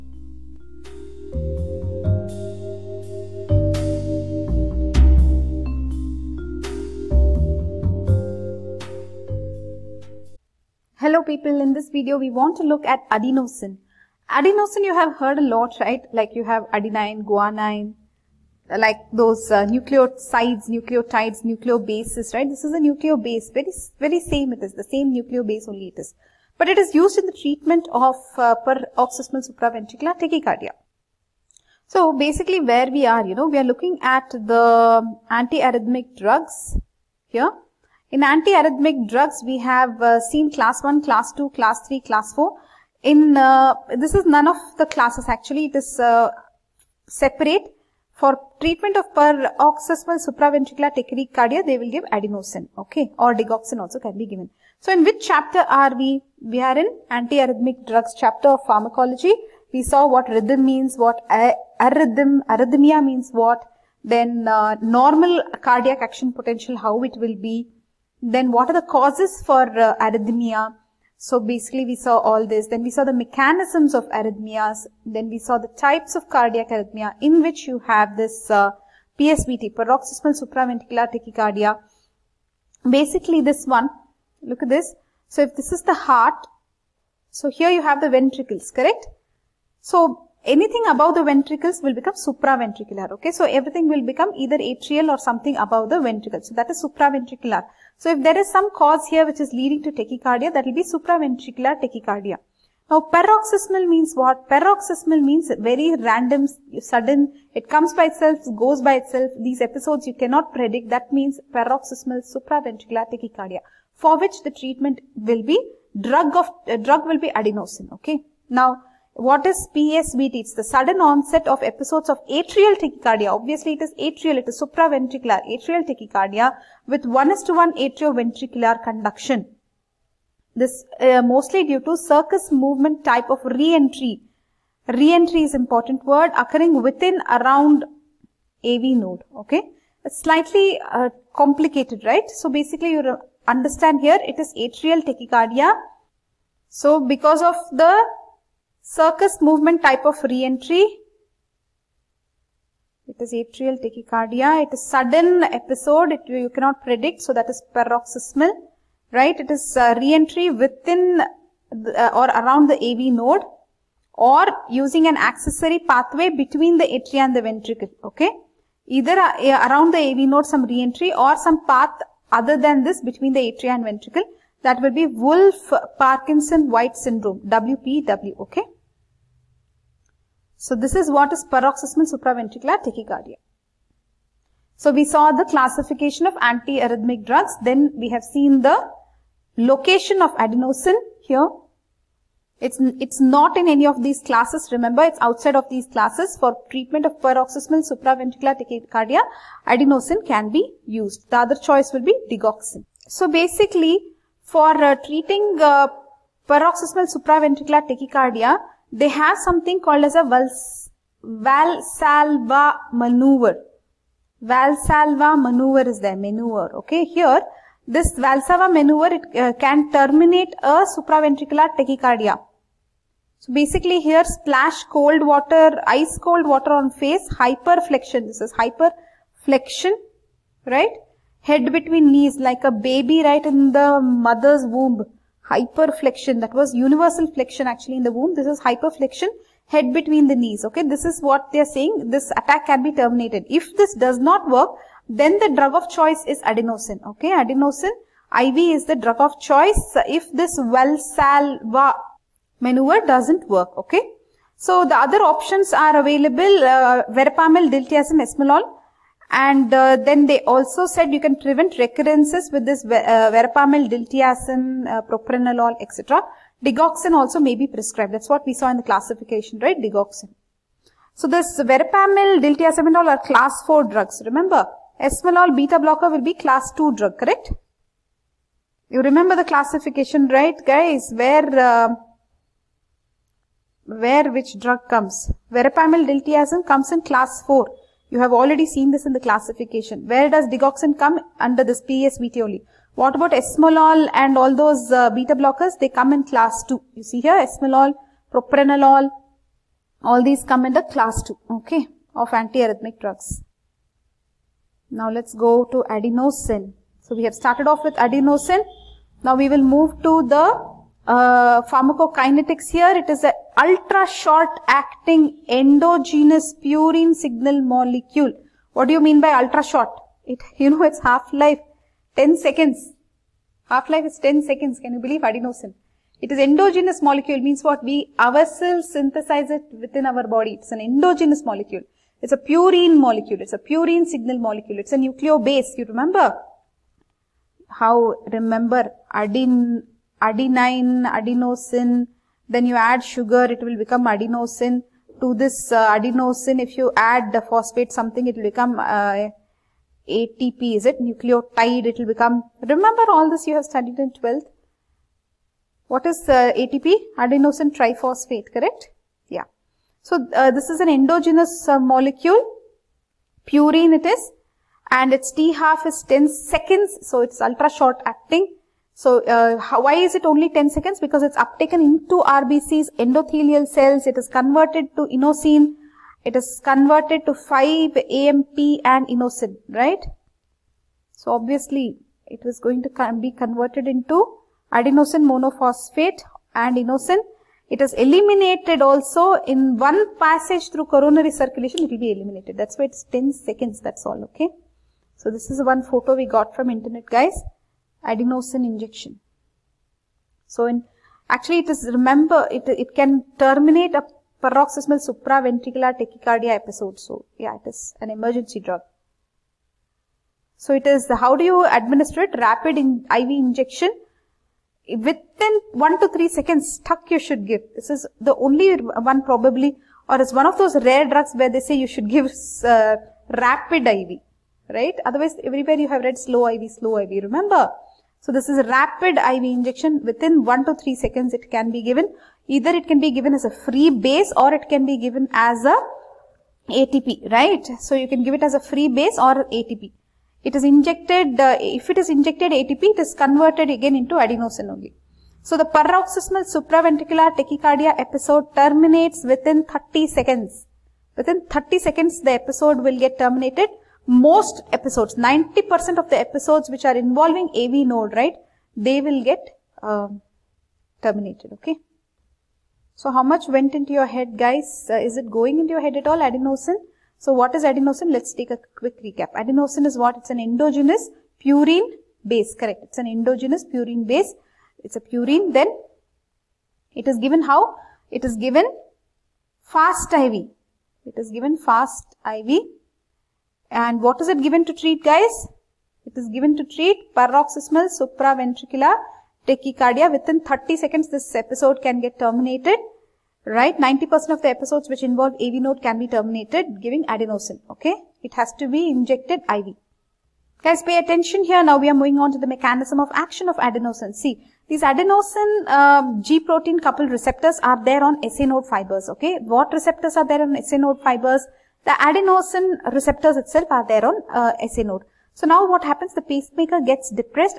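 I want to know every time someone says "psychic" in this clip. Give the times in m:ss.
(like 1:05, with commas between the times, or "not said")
not said.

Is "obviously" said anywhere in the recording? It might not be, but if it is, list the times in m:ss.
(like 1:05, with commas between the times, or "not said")
2:03, 6:21.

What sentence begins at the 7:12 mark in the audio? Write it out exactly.
Either it can be given as a free base or it can be given as a ATP, right?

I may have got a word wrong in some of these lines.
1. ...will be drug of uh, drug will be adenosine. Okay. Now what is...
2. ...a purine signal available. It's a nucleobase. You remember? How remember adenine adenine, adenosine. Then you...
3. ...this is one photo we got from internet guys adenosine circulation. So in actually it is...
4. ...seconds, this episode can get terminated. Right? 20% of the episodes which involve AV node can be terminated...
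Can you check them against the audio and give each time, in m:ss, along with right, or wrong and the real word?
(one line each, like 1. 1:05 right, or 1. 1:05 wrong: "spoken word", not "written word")
1. 1:55 right
2. 5:33 wrong: "molecule", not "available"
3. 6:35 wrong: "injection", not "circulation"
4. 8:10 wrong: "90", not "20".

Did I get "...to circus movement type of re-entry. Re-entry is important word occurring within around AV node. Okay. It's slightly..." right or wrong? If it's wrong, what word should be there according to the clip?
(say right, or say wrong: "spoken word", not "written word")
right.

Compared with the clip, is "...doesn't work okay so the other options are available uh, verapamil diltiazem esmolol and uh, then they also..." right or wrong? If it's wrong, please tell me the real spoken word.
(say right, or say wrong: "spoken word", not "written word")
right.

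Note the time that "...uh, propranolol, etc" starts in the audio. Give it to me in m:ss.
4:24.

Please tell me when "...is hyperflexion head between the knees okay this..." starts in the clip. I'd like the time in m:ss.
3:58.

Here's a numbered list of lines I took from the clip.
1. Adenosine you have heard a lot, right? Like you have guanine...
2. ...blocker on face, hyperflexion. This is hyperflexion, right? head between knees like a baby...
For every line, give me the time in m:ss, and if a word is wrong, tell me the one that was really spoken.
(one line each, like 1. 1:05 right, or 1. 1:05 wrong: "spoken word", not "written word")
1. 0:14 wrong: "adenine", not "guanine"
2. 3:46 wrong: "water", not "blocker".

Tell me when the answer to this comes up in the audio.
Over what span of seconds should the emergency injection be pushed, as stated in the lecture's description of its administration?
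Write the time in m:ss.
6:55.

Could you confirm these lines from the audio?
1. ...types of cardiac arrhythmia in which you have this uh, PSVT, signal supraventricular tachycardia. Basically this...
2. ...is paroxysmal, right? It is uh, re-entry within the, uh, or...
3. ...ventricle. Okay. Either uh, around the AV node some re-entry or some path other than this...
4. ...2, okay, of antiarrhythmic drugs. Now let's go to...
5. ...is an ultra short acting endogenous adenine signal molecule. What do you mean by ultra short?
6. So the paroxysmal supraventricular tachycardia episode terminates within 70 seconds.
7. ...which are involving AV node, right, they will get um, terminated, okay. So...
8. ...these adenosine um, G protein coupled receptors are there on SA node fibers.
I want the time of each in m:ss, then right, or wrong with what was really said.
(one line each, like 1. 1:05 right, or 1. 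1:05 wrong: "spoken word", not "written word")
1. 1:15 wrong: "paroxysmal", not "signal"
2. 2:37 right
3. 2:47 right
4. 5:01 right
5. 5:13 wrong: "purine", not "adenine"
6. 7:25 wrong: "30", not "70"
7. 7:36 right
8. 8:24 right.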